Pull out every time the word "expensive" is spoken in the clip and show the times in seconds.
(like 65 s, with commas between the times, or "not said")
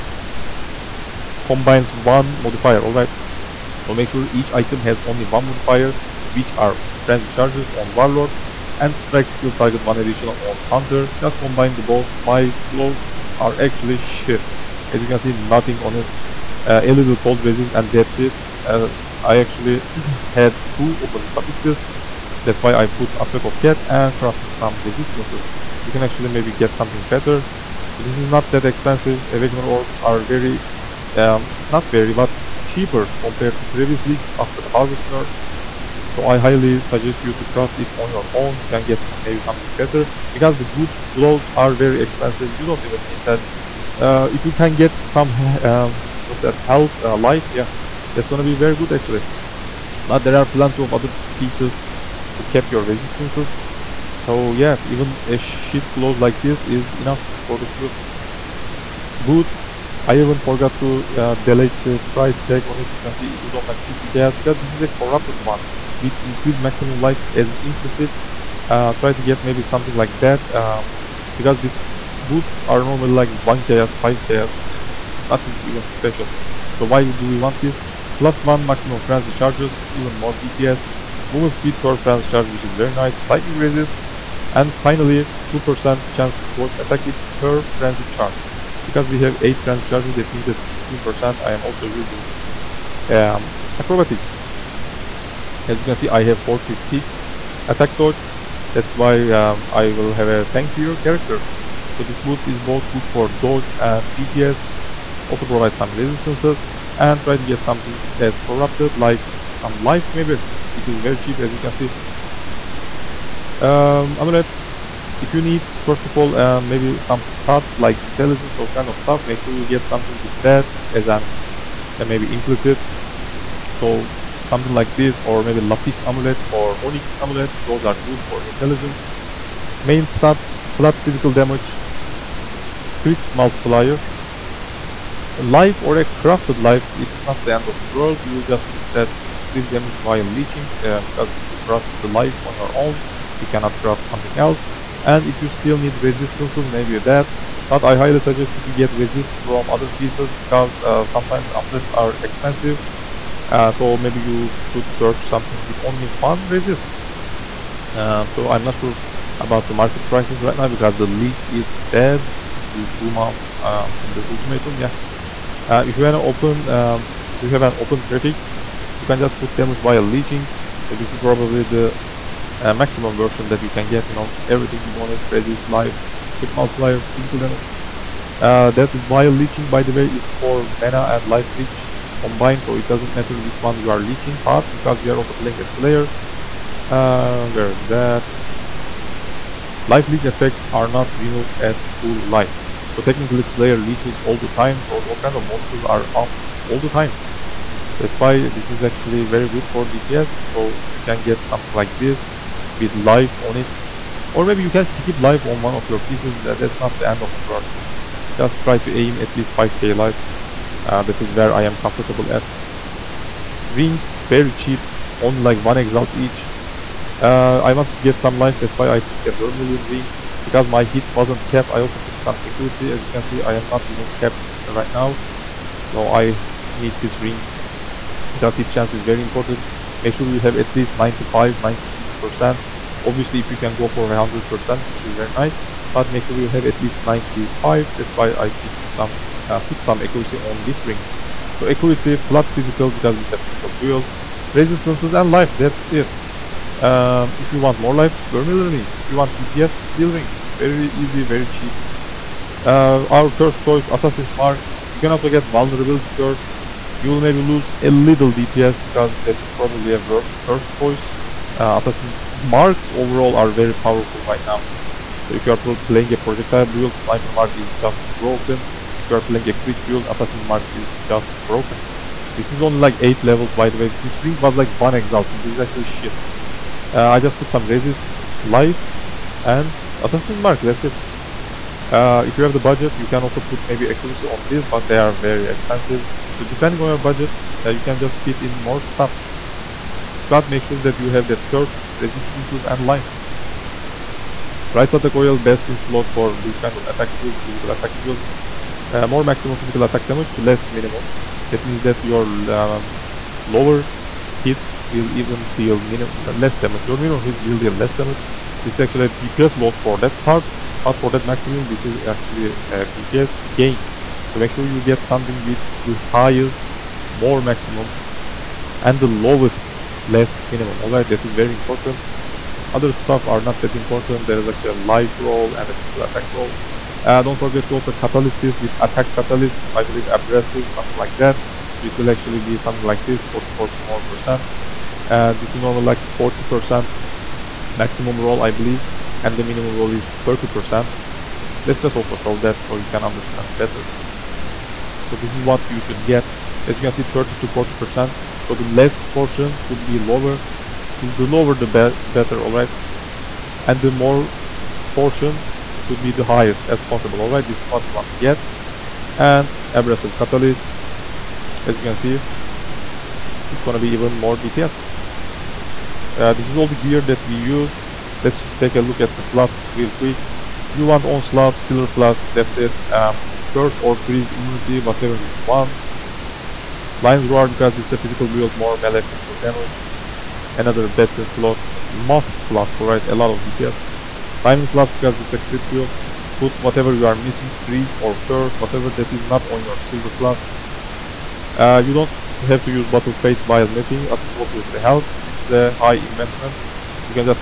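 28 s, 42 s, 152 s, 285 s.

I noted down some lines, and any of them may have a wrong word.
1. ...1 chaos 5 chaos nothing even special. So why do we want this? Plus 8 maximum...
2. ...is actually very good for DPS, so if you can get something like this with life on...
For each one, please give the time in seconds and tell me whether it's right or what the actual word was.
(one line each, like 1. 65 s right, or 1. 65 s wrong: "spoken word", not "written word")
1. 73 s wrong: "1", not "8"
2. 198 s right.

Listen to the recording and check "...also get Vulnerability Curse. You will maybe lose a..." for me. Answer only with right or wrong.
right.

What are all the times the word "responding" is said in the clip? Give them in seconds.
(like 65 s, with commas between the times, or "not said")
not said.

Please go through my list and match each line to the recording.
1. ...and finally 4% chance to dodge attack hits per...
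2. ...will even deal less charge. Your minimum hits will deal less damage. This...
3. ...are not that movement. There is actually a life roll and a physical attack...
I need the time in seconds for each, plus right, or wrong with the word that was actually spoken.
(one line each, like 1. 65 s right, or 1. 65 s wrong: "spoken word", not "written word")
1. 84 s wrong: "2", not "4"
2. 304 s wrong: "damage", not "charge"
3. 323 s wrong: "important", not "movement".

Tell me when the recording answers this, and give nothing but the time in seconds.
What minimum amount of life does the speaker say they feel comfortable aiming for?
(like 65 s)
209 s.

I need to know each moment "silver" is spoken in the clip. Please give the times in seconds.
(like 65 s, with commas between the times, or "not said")
371 s, 389 s.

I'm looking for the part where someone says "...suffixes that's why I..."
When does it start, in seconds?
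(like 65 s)
21 s.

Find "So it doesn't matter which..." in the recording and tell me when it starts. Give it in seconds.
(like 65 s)
182 s.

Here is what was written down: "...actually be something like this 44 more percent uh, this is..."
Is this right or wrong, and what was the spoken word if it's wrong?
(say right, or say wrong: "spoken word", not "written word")
right.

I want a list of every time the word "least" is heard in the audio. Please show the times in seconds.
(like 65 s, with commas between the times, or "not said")
209 s, 230 s, 236 s.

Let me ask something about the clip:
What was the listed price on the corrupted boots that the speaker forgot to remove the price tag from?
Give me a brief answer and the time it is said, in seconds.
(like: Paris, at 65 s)
50k, at 63 s.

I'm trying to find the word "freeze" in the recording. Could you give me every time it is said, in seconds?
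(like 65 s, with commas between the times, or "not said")
373 s, 387 s.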